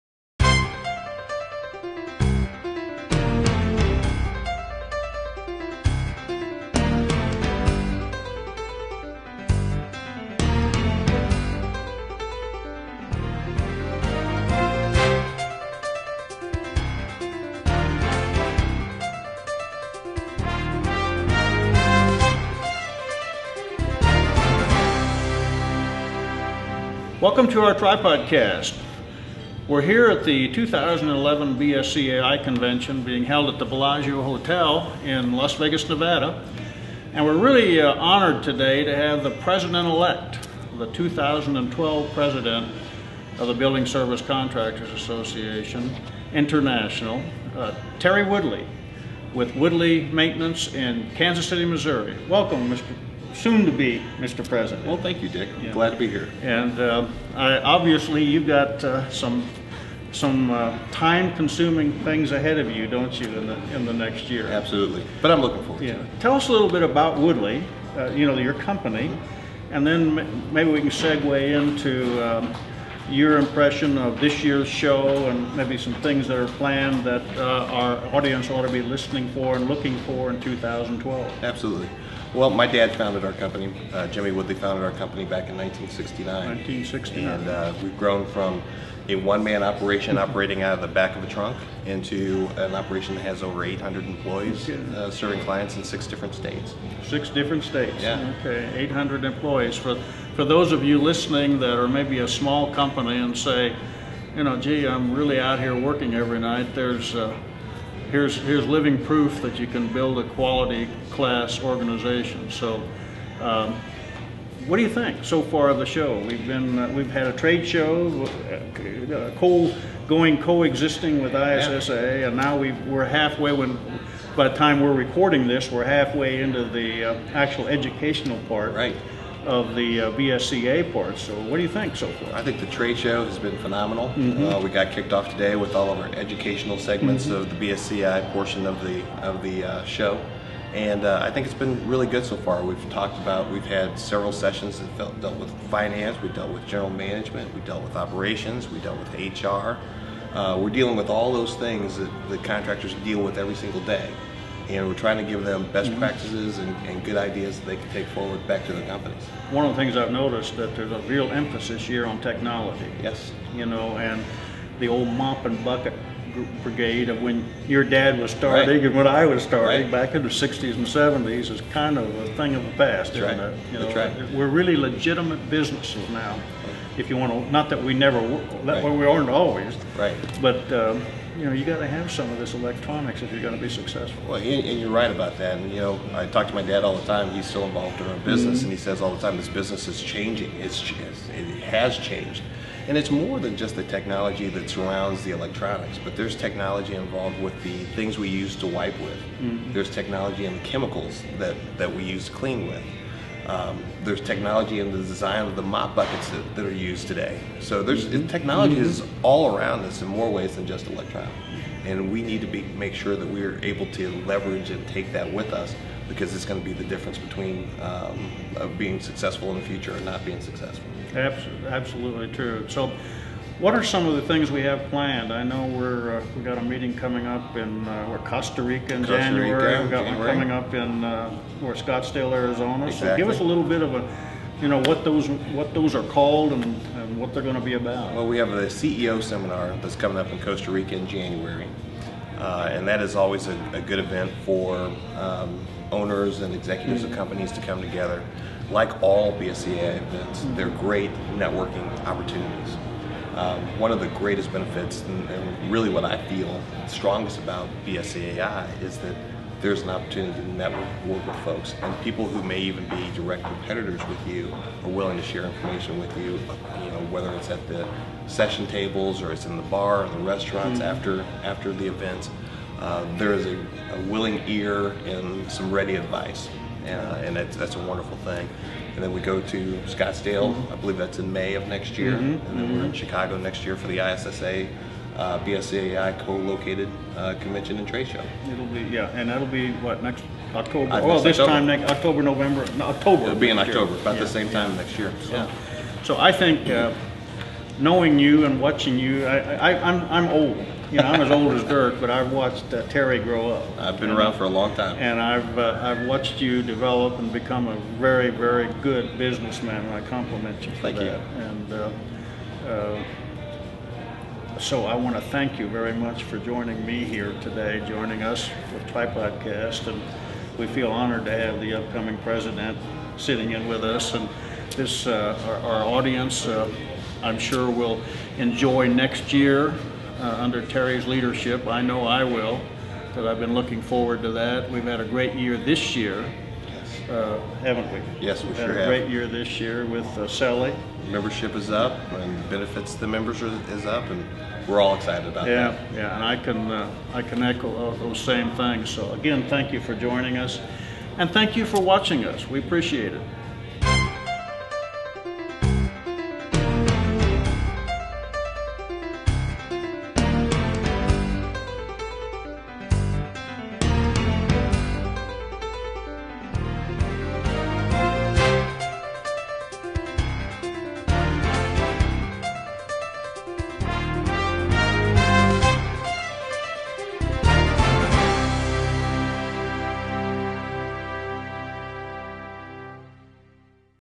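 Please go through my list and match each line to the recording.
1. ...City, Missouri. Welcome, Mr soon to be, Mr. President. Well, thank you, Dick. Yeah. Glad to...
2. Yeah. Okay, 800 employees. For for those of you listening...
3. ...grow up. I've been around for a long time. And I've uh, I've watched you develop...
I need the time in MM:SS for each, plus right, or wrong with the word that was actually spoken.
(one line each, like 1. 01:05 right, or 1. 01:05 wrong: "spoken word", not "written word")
1. 00:51 right
2. 01:38 right
3. 05:03 right.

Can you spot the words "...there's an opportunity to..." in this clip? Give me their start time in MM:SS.
04:19.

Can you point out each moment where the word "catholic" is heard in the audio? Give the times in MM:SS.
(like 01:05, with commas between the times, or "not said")
not said.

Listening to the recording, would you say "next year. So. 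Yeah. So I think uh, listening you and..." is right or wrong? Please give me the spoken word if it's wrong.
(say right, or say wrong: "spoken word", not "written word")
wrong: "knowing", not "listening".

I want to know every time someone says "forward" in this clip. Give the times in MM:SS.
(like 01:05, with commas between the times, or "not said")
01:05, 02:38, 05:33.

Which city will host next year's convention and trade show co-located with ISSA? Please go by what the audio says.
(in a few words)
Chicago.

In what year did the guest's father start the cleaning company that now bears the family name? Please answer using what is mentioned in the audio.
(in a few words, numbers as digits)
1969.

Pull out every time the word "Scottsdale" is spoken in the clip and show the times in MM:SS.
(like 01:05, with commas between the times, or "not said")
03:51, 04:39.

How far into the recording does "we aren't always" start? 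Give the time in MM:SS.
02:58.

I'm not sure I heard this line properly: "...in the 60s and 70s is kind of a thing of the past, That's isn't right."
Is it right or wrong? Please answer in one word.
right.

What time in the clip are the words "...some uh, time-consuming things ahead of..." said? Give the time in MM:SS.
01:00.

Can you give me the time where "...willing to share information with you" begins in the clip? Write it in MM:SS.
04:24.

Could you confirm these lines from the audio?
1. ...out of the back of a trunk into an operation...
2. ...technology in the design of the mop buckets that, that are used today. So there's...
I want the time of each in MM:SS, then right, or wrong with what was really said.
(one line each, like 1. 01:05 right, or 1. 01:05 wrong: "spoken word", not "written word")
1. 01:30 right
2. 03:24 right.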